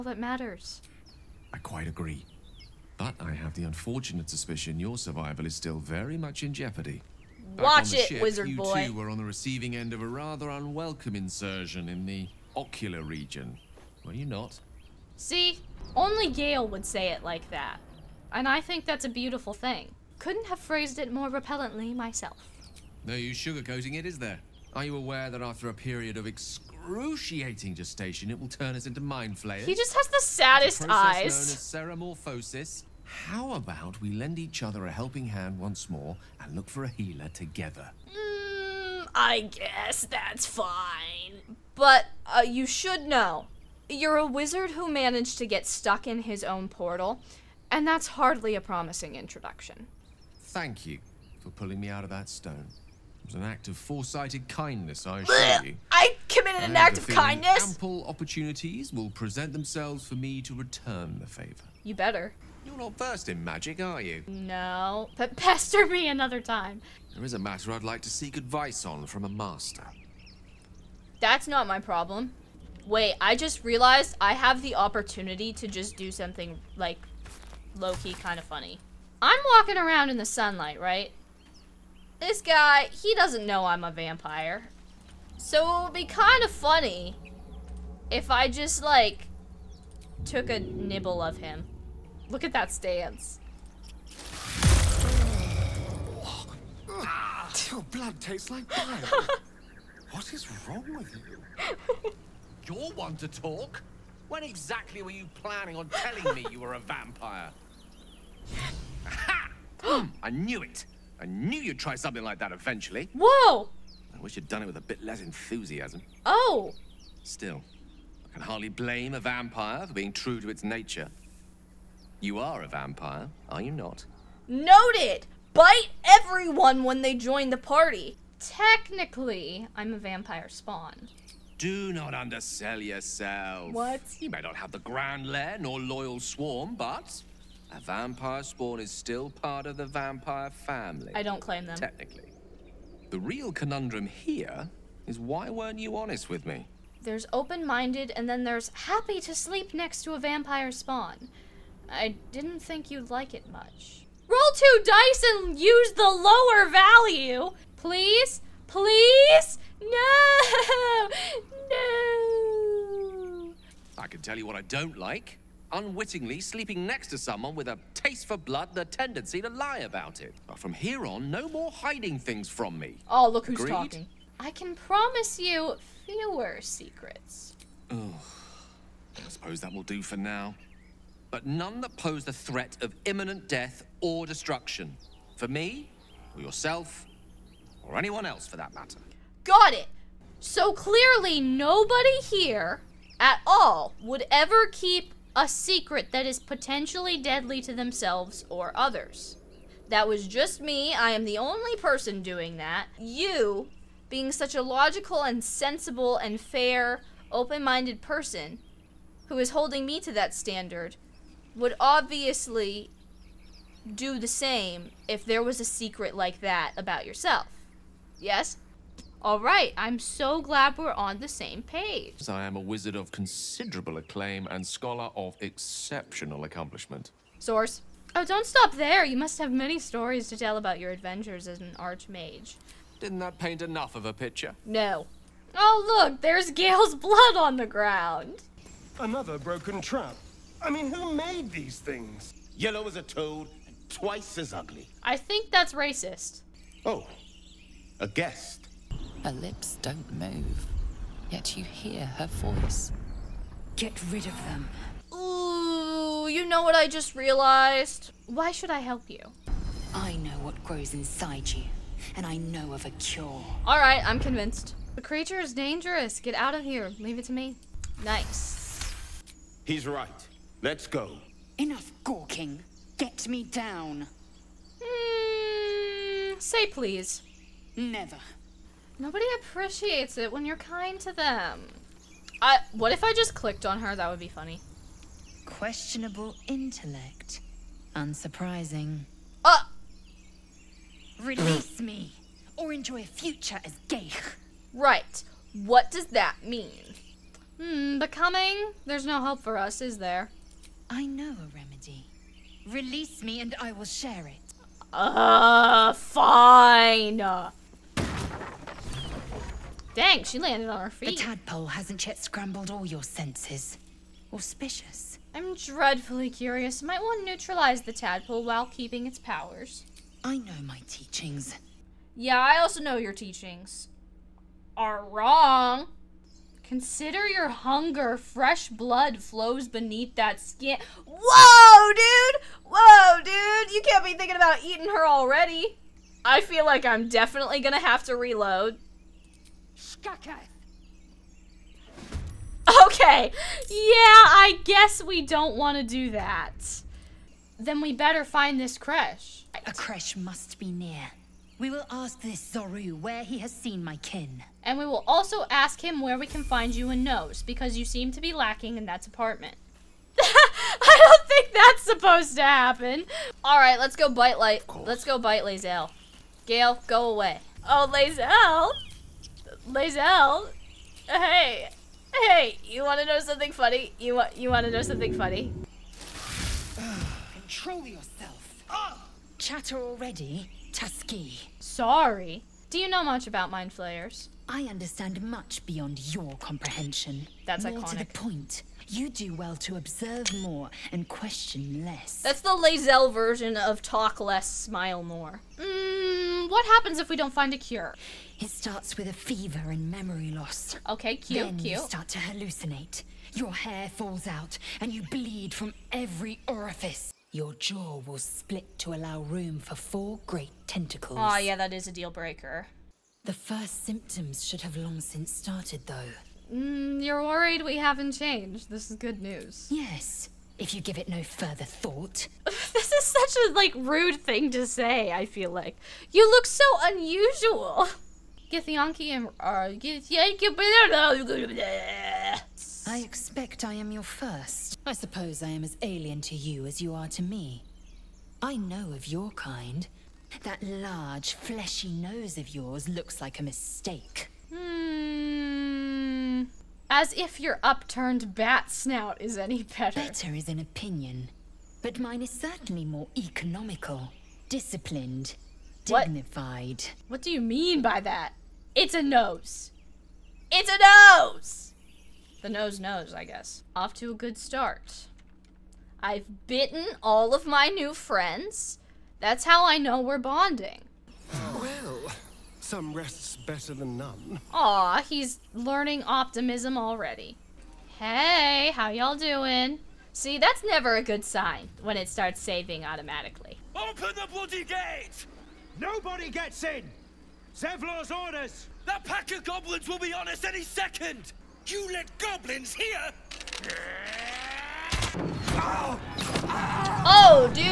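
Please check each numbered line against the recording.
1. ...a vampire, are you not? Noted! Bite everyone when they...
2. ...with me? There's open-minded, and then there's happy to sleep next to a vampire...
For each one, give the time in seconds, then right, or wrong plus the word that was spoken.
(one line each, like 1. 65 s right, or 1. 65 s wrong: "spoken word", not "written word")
1. 122 s right
2. 146 s right.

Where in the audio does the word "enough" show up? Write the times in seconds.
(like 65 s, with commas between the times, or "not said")
233 s, 271 s.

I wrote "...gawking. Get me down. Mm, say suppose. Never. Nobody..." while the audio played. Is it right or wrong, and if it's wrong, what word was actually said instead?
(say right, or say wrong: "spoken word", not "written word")
wrong: "please", not "suppose".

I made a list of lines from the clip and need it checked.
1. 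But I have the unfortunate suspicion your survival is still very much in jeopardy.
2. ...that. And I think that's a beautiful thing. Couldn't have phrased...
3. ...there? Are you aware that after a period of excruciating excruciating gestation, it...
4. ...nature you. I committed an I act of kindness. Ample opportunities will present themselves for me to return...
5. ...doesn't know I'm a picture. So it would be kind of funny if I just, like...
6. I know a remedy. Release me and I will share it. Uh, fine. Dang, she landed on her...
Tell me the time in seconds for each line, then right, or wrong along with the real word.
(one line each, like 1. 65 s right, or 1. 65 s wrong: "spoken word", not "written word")
1. 2 s right
2. 17 s right
3. 24 s right
4. 55 s wrong: "assure", not "nature"
5. 83 s wrong: "vampire", not "picture"
6. 300 s right.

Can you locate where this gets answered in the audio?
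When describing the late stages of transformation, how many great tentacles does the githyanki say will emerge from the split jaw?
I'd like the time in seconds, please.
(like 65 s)
409 s.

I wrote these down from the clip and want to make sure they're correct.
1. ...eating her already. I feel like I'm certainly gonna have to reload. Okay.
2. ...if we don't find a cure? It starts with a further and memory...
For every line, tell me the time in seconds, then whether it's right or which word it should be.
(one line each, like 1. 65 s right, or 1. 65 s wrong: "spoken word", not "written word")
1. 334 s wrong: "definitely", not "certainly"
2. 396 s wrong: "fever", not "further".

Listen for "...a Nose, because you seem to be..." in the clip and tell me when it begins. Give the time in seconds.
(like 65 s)
356 s.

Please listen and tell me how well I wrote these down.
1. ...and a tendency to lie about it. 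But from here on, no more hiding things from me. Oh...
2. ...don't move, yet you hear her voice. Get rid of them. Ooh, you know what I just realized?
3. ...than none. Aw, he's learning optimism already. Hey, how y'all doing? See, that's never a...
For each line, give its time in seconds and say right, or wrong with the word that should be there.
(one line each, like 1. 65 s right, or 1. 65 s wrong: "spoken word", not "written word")
1. 168 s right
2. 249 s right
3. 473 s right.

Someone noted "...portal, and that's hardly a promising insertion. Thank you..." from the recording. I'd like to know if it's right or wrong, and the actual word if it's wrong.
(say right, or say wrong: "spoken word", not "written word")
wrong: "introduction", not "insertion".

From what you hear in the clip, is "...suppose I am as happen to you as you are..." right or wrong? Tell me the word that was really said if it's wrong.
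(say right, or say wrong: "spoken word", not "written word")
wrong: "alien", not "happen".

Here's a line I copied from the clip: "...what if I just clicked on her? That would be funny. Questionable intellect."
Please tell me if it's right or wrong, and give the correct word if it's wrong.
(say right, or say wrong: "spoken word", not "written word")
right.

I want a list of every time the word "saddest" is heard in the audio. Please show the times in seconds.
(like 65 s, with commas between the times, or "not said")
30 s.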